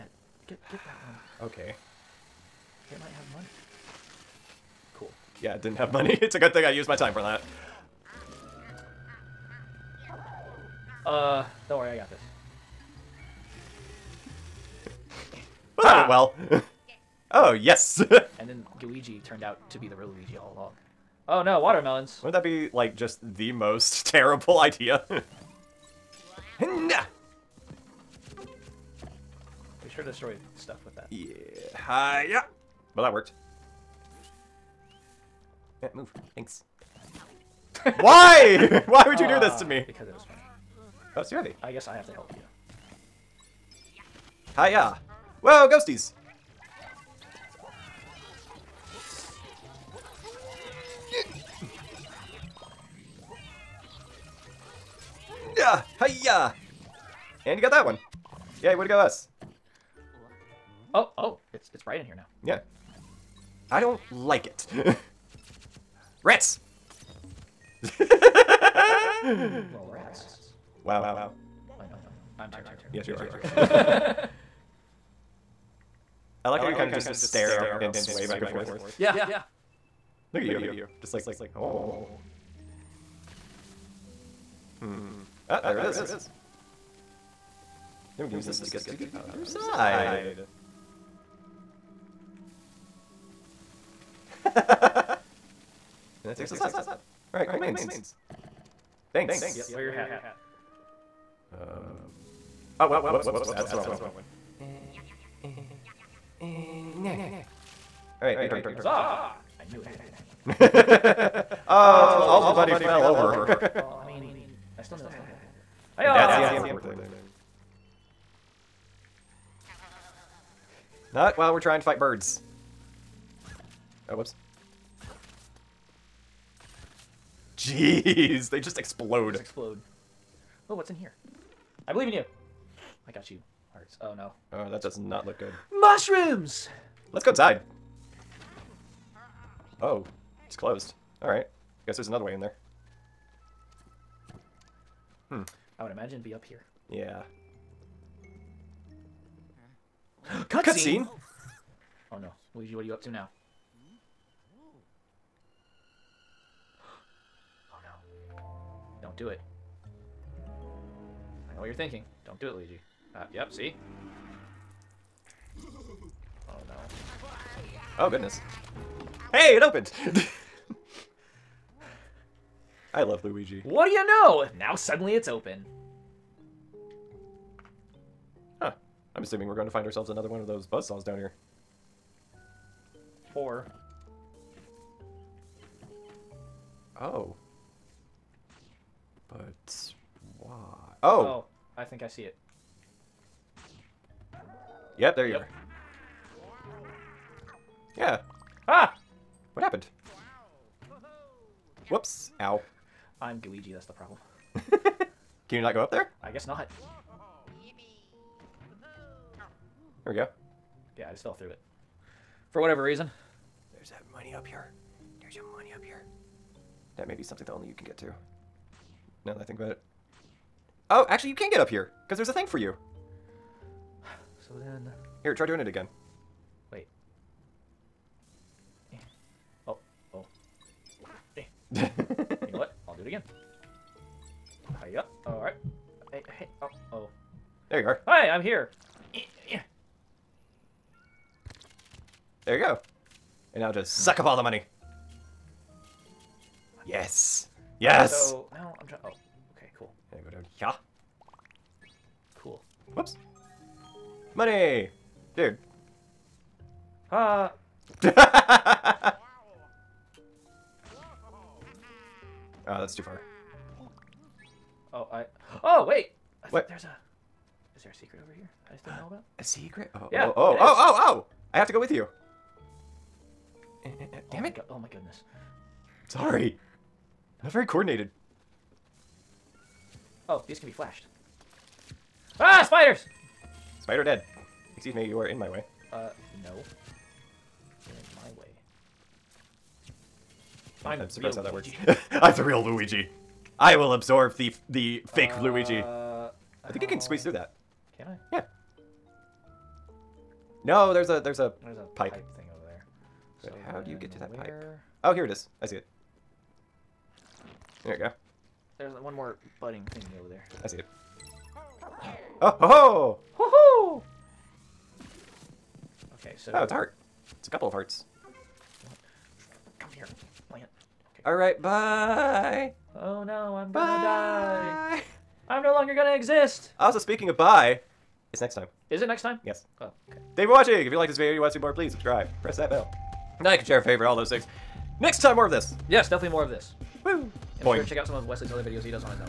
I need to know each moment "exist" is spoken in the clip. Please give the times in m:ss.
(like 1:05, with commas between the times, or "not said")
5:26.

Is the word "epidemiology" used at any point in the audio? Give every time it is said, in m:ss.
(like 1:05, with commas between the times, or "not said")
not said.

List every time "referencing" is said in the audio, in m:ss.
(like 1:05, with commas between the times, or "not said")
not said.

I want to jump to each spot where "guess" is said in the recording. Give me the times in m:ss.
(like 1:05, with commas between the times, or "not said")
0:41, 2:21, 3:26.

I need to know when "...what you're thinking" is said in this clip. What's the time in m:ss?
2:41.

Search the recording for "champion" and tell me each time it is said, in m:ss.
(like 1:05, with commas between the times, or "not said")
not said.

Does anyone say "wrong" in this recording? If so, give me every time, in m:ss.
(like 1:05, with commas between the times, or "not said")
1:43.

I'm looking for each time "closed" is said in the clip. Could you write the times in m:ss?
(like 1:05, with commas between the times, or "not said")
2:20.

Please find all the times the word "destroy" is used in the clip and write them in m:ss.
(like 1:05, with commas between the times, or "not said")
0:30.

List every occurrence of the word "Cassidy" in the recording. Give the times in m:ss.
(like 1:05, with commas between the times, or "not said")
not said.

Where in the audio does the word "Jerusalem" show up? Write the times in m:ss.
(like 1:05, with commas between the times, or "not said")
not said.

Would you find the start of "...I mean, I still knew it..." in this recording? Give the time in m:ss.
1:54.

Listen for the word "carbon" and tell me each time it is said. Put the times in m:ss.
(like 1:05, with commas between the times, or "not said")
not said.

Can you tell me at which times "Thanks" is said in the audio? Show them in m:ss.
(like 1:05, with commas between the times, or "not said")
0:36, 1:39, 5:30.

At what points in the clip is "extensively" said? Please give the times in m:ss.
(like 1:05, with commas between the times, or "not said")
not said.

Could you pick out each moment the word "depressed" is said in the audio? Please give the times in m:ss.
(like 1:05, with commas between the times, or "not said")
not said.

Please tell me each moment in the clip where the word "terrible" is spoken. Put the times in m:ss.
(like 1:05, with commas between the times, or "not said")
0:24, 1:12.